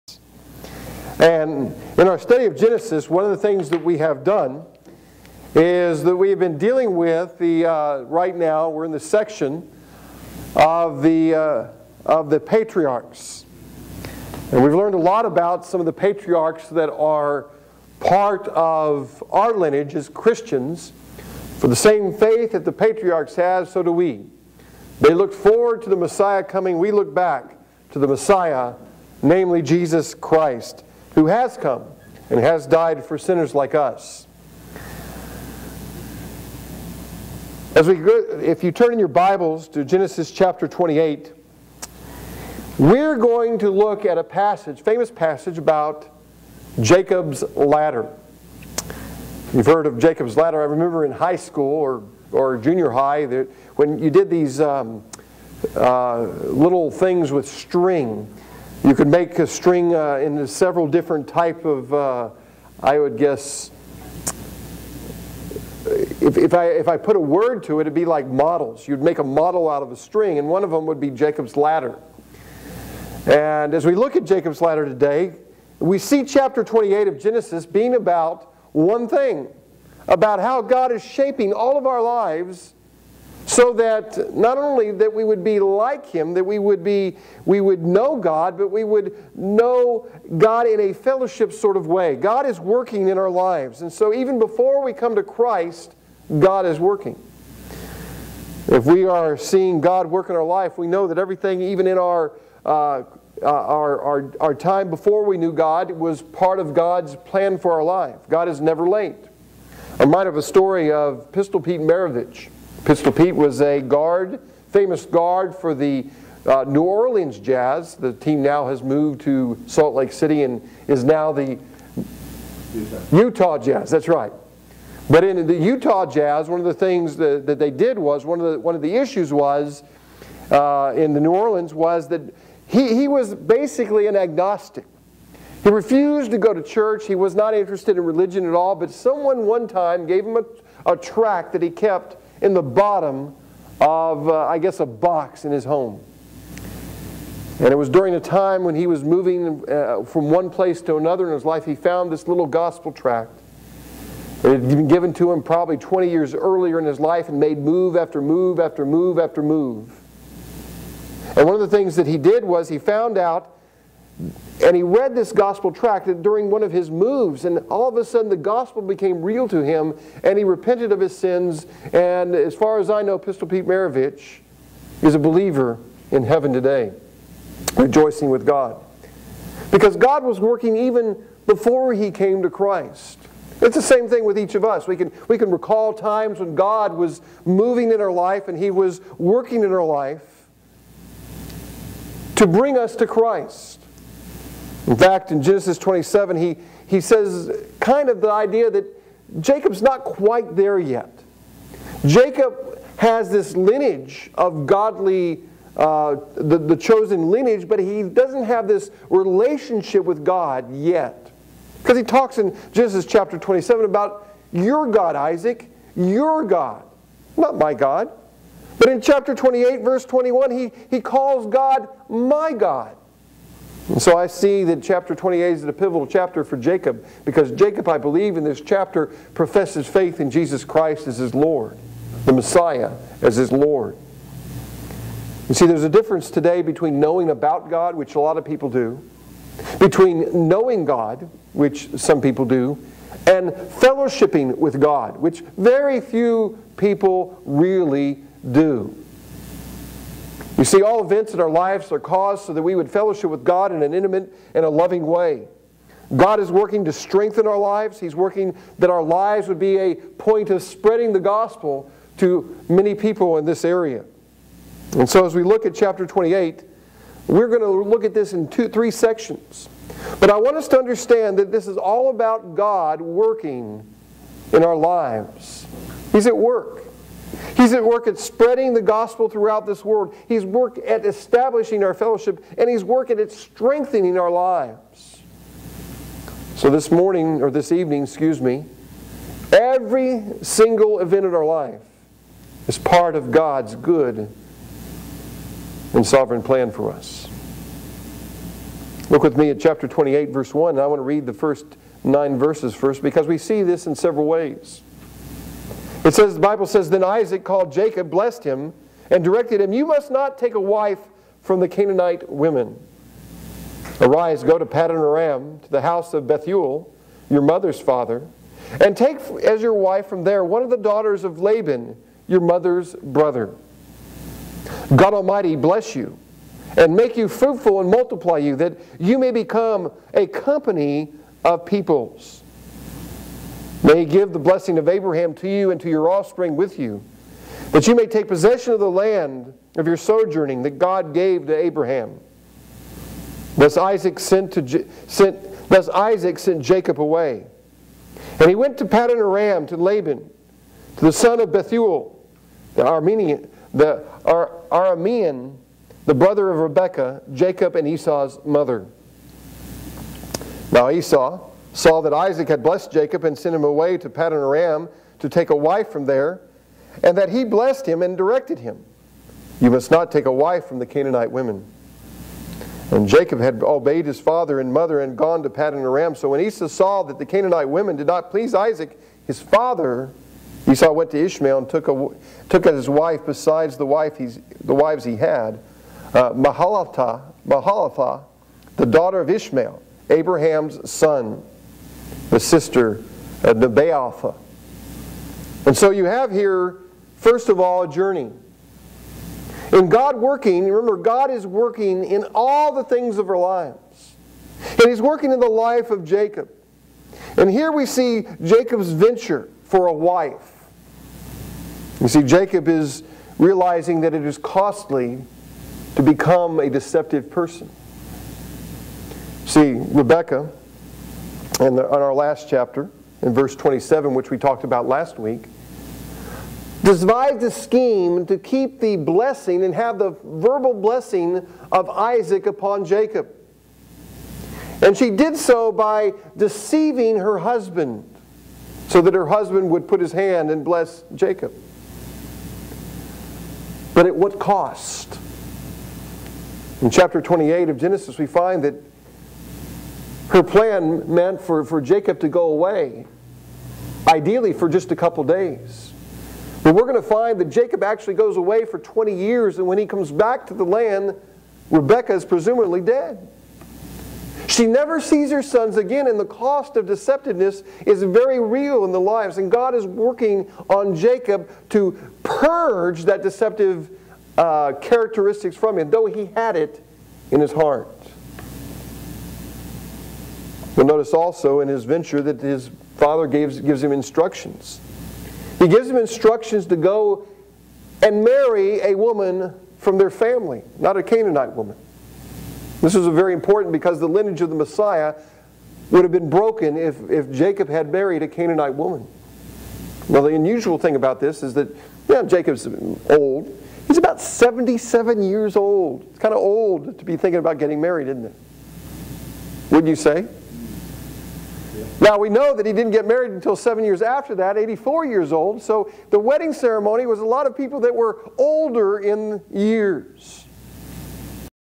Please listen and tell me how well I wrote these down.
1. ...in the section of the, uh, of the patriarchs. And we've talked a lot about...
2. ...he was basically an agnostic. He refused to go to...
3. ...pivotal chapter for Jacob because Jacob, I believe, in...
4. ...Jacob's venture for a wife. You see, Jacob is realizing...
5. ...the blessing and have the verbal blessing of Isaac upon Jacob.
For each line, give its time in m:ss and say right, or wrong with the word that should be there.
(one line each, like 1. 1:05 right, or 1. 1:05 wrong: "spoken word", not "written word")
1. 0:08 wrong: "learned", not "talked"
2. 2:12 right
3. 3:45 right
4. 6:48 right
5. 7:08 right.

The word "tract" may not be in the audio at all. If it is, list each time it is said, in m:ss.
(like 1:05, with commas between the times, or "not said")
2:20, 2:32, 2:45.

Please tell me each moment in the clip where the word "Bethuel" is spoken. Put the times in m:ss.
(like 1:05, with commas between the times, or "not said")
5:16, 5:51.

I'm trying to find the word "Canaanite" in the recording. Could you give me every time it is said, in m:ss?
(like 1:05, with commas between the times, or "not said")
5:11, 6:10, 6:17, 8:11, 8:18.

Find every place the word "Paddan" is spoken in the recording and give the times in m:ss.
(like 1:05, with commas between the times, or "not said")
5:14, 5:48, 6:04, 6:15.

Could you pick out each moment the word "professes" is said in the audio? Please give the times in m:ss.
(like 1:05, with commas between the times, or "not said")
3:49.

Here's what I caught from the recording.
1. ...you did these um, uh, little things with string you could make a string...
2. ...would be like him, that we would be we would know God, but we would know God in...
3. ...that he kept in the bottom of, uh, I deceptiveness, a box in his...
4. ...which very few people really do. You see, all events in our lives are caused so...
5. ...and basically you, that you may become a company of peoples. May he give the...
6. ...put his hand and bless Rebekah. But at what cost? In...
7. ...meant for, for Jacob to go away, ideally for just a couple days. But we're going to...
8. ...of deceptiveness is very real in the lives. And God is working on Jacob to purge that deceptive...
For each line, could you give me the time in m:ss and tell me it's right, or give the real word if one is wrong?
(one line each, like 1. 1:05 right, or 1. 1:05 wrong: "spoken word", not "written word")
1. 0:53 right
2. 1:25 right
3. 2:21 wrong: "guess", not "deceptiveness"
4. 4:05 right
5. 5:27 wrong: "multiply", not "basically"
6. 7:19 wrong: "Jacob", not "Rebekah"
7. 7:31 right
8. 7:46 right.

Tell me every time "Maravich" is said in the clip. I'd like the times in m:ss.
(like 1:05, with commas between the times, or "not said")
1:51, 2:53.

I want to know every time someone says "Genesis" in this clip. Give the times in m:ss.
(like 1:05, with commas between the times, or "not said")
0:02, 0:39, 1:17, 3:15, 3:32, 7:27.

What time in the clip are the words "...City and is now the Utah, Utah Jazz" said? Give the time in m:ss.
2:00.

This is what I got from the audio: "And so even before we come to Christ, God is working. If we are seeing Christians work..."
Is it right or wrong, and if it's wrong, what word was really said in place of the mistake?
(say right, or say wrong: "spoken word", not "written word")
wrong: "God", not "Christians".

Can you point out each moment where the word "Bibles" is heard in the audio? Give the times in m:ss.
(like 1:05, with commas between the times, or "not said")
0:39, 5:06.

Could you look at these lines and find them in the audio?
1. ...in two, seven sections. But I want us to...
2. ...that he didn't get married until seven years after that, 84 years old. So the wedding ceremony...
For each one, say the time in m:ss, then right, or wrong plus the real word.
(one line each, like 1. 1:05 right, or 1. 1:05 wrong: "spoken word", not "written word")
1. 4:28 wrong: "three", not "seven"
2. 8:32 right.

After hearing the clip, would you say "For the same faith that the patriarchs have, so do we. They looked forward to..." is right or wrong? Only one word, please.
right.